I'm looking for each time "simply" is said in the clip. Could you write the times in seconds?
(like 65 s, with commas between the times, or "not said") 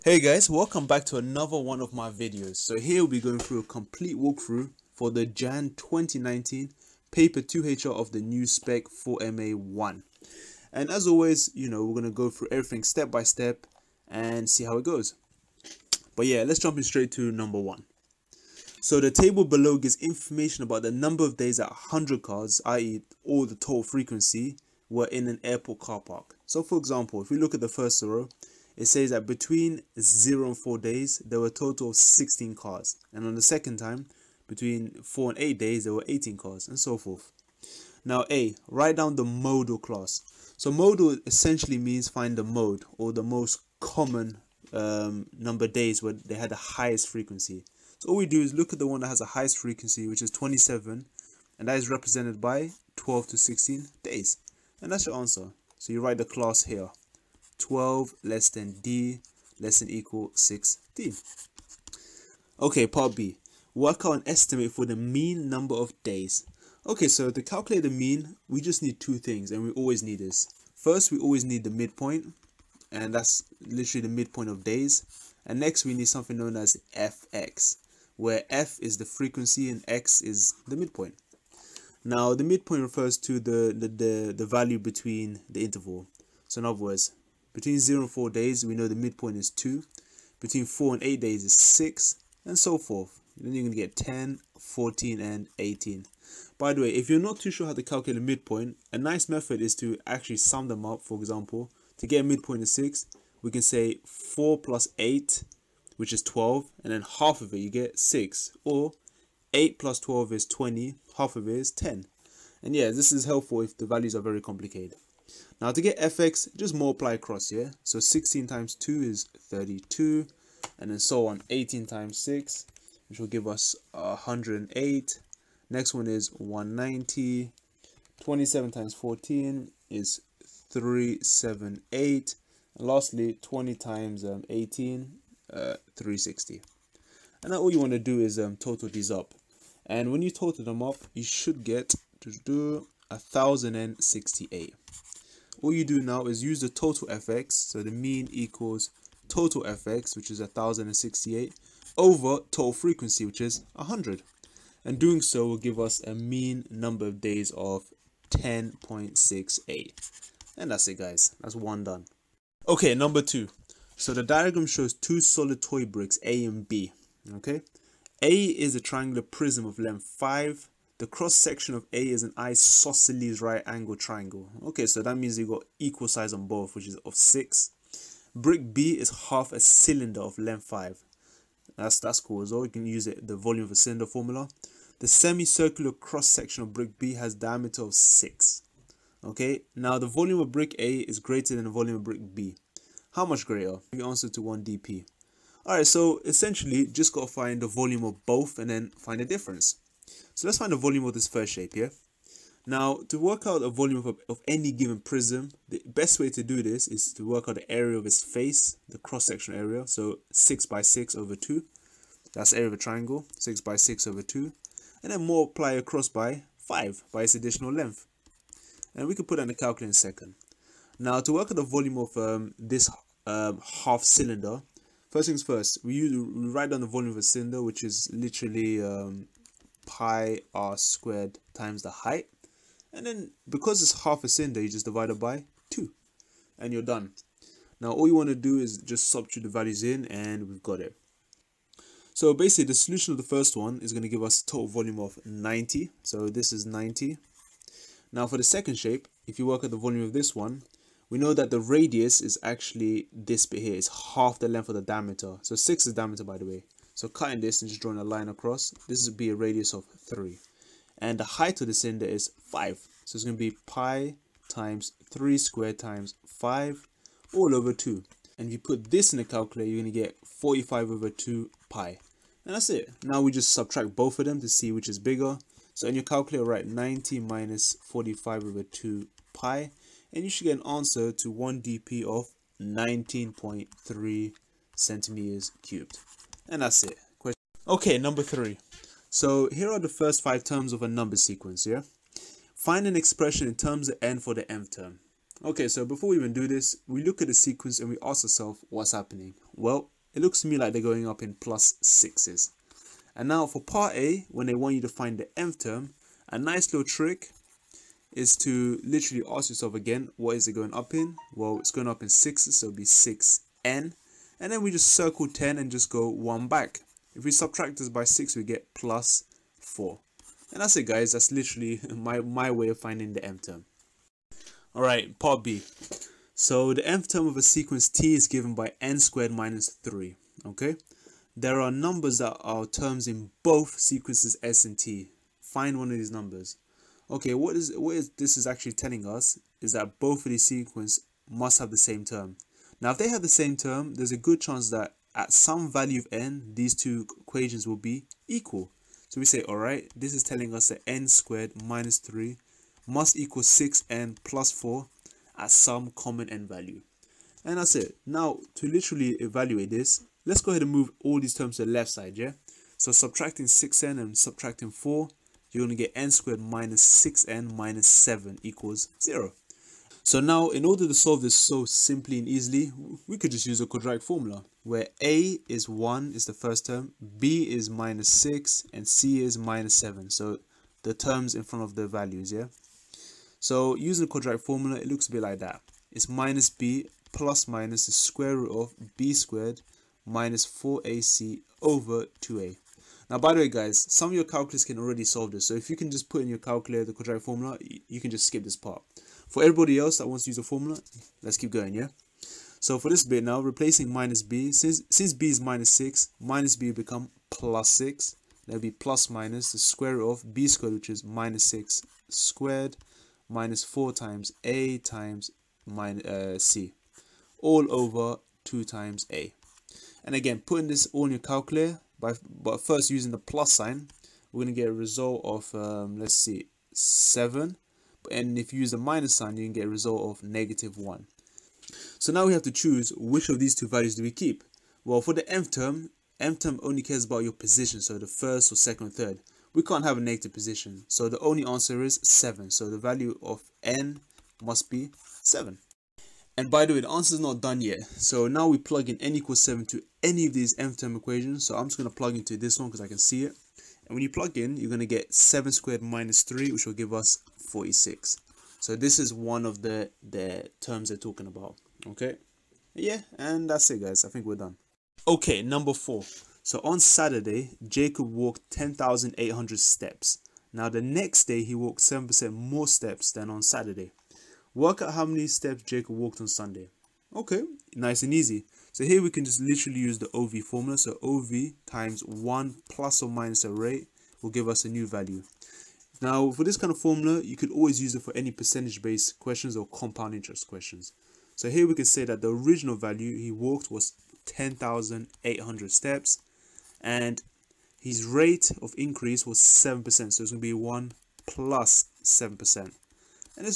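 371 s.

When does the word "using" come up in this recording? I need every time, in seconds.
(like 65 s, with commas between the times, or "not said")
383 s, 422 s.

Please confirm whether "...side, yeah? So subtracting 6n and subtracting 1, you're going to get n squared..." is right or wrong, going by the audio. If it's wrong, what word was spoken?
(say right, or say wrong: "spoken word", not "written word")
wrong: "4", not "1".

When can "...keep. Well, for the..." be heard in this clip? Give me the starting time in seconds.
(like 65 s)
434 s.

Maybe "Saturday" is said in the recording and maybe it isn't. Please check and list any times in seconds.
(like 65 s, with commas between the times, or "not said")
466 s, 473 s.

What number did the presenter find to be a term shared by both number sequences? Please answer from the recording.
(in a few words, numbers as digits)
46.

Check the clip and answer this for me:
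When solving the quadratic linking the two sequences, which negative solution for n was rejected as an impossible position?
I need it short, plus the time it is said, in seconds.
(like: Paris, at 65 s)
-1, at 430 s.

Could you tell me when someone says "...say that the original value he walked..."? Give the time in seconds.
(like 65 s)
491 s.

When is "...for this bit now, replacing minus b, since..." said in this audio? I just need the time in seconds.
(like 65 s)
402 s.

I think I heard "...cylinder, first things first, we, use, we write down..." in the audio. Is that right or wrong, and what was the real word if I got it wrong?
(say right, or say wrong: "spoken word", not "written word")
right.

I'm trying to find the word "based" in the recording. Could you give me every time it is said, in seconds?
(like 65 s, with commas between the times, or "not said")
488 s.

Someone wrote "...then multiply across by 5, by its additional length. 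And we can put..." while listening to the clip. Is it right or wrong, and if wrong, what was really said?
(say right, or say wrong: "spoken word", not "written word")
right.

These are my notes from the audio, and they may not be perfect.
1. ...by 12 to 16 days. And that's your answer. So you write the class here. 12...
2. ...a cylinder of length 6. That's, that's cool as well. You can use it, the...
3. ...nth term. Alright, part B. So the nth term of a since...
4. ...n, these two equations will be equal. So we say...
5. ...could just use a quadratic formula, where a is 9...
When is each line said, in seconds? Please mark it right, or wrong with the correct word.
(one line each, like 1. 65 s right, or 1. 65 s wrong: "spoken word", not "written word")
1. 52 s right
2. 179 s wrong: "5", not "6"
3. 323 s wrong: "sequence", not "since"
4. 346 s right
5. 373 s wrong: "1", not "9".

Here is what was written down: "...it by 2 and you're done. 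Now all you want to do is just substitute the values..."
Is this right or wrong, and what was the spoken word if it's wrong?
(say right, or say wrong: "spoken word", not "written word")
right.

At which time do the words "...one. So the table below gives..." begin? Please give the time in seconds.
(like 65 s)
17 s.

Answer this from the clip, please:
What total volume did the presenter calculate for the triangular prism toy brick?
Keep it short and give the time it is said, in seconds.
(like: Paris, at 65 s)
90, at 244 s.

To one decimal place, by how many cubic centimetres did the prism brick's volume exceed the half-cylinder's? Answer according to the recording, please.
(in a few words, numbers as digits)
19.3.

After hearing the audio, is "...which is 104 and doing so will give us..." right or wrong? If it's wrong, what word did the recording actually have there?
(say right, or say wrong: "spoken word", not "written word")
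wrong: "100", not "104".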